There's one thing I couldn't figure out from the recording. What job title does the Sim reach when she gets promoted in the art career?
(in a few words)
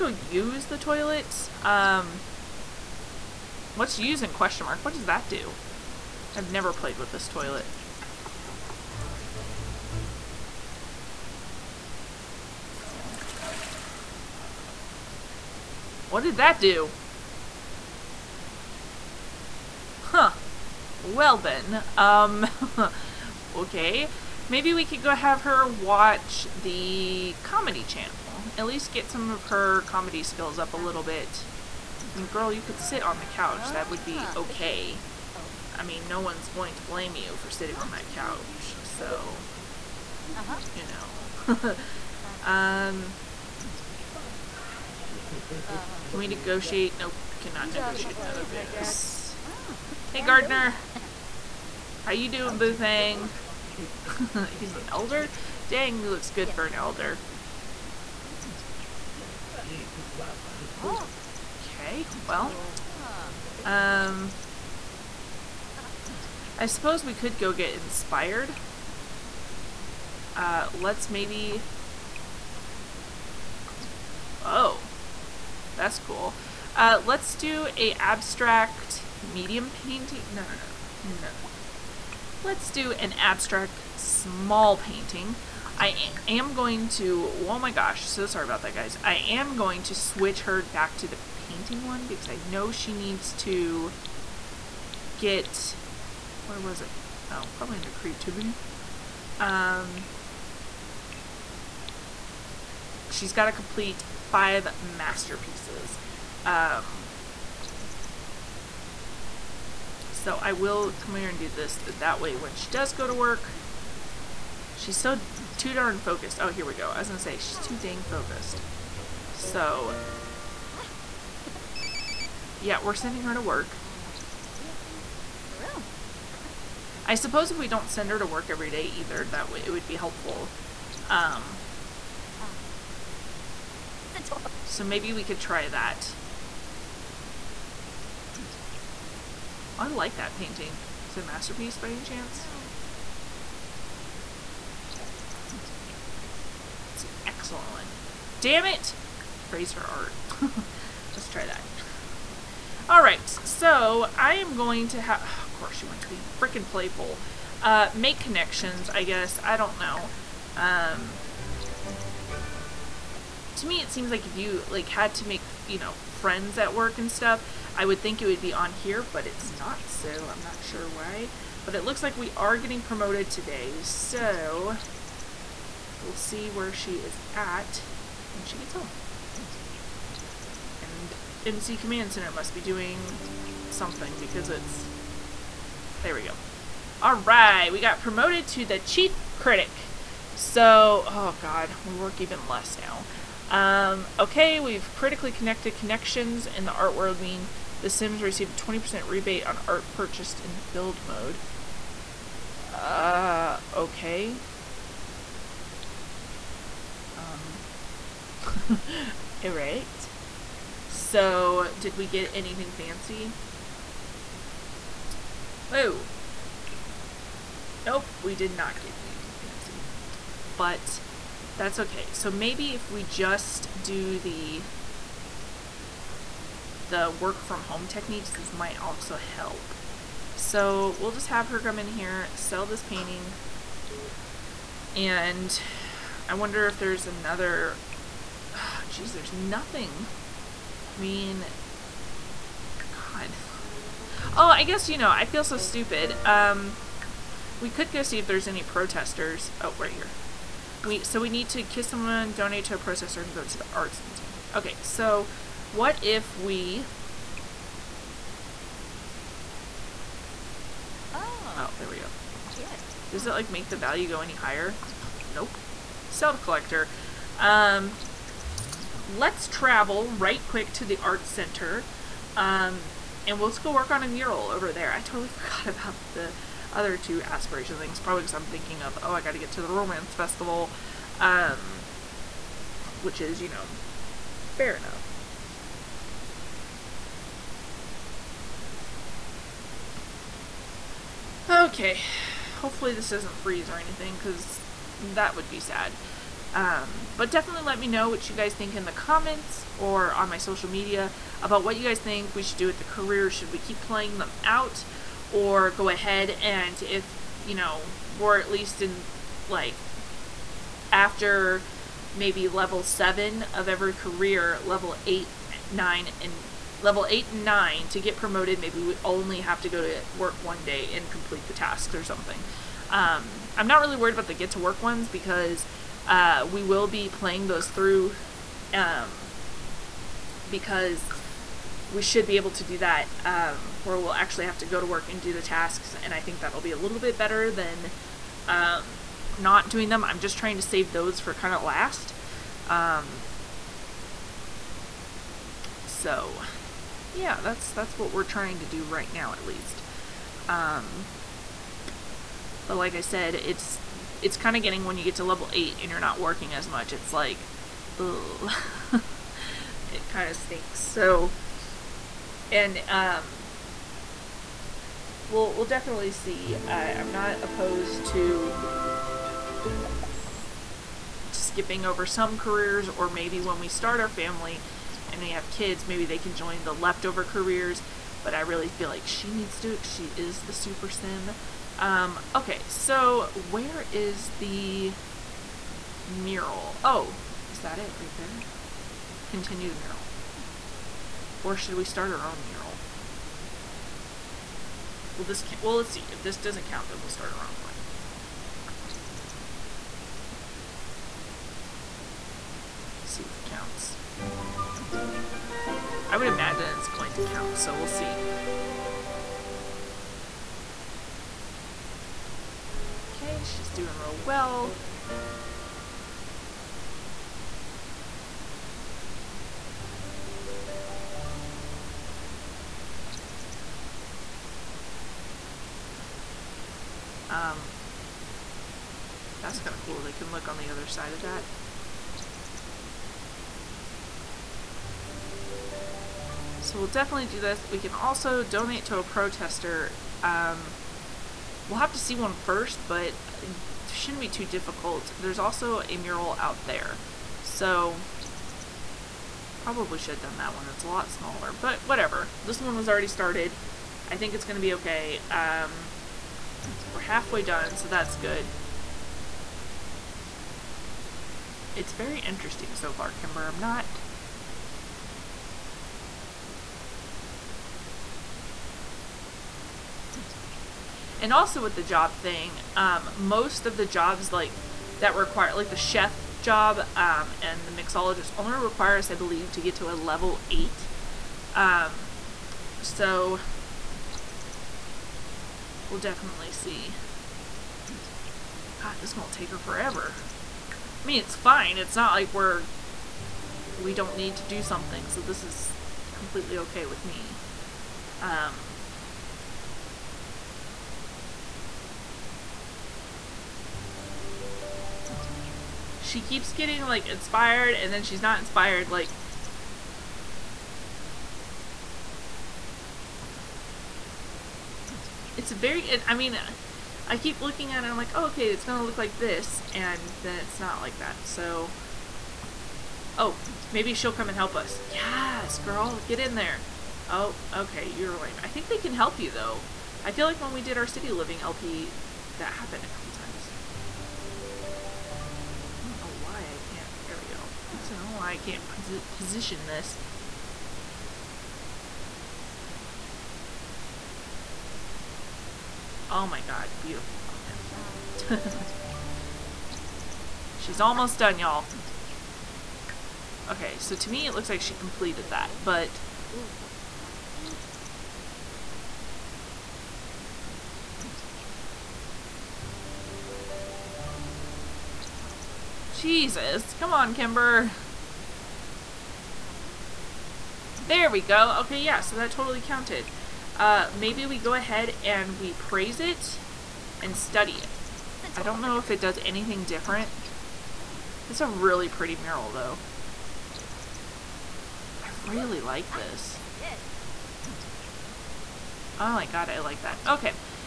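Chief critic.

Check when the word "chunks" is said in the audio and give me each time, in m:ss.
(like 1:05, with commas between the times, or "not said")
not said.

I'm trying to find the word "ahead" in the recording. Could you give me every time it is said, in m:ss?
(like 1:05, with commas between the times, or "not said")
5:05, 9:34.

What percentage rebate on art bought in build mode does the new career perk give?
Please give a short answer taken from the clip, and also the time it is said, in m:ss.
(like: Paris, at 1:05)
20%, at 3:18.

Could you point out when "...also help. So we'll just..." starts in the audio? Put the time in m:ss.
3:48.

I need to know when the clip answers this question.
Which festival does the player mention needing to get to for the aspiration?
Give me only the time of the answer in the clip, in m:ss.
4:39.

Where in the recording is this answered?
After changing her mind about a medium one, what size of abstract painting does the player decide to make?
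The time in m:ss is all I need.
1:23.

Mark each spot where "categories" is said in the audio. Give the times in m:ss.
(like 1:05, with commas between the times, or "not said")
not said.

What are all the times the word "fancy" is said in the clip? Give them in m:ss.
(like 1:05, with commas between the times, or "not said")
3:32, 3:39.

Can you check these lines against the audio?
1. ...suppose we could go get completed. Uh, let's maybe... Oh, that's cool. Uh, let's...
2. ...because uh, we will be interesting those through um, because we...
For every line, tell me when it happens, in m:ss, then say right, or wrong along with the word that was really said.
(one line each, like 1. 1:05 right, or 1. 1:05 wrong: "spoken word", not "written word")
1. 1:06 wrong: "inspired", not "completed"
2. 5:25 wrong: "playing", not "interesting".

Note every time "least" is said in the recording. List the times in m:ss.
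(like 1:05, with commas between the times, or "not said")
0:28, 5:08, 5:49.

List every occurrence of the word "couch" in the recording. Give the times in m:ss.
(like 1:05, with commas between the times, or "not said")
0:33, 0:38.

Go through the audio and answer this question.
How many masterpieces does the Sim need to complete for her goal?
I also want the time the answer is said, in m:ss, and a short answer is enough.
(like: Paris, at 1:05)
5, at 1:44.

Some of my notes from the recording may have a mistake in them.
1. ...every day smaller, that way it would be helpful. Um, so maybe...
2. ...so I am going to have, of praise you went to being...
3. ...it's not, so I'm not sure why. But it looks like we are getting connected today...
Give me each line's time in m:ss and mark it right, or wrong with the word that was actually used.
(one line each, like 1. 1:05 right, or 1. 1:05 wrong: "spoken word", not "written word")
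1. 2:08 wrong: "either", not "smaller"
2. 2:33 wrong: "course", not "praise"
3. 2:49 wrong: "promoted", not "connected".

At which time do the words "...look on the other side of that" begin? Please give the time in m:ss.
7:10.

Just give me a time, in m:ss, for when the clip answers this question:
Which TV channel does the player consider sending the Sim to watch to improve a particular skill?
0:26.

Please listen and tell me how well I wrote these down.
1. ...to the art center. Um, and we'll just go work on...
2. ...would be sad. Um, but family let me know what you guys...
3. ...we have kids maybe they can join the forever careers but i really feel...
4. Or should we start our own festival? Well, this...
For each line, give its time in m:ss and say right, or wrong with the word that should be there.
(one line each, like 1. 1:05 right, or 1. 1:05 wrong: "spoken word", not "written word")
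1. 4:30 right
2. 4:55 wrong: "definitely", not "family"
3. 6:15 wrong: "leftover", not "forever"
4. 6:31 wrong: "mural", not "festival".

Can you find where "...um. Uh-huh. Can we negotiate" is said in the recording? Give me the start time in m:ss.
0:42.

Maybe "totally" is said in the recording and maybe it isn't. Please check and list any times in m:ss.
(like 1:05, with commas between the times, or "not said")
4:35, 9:32.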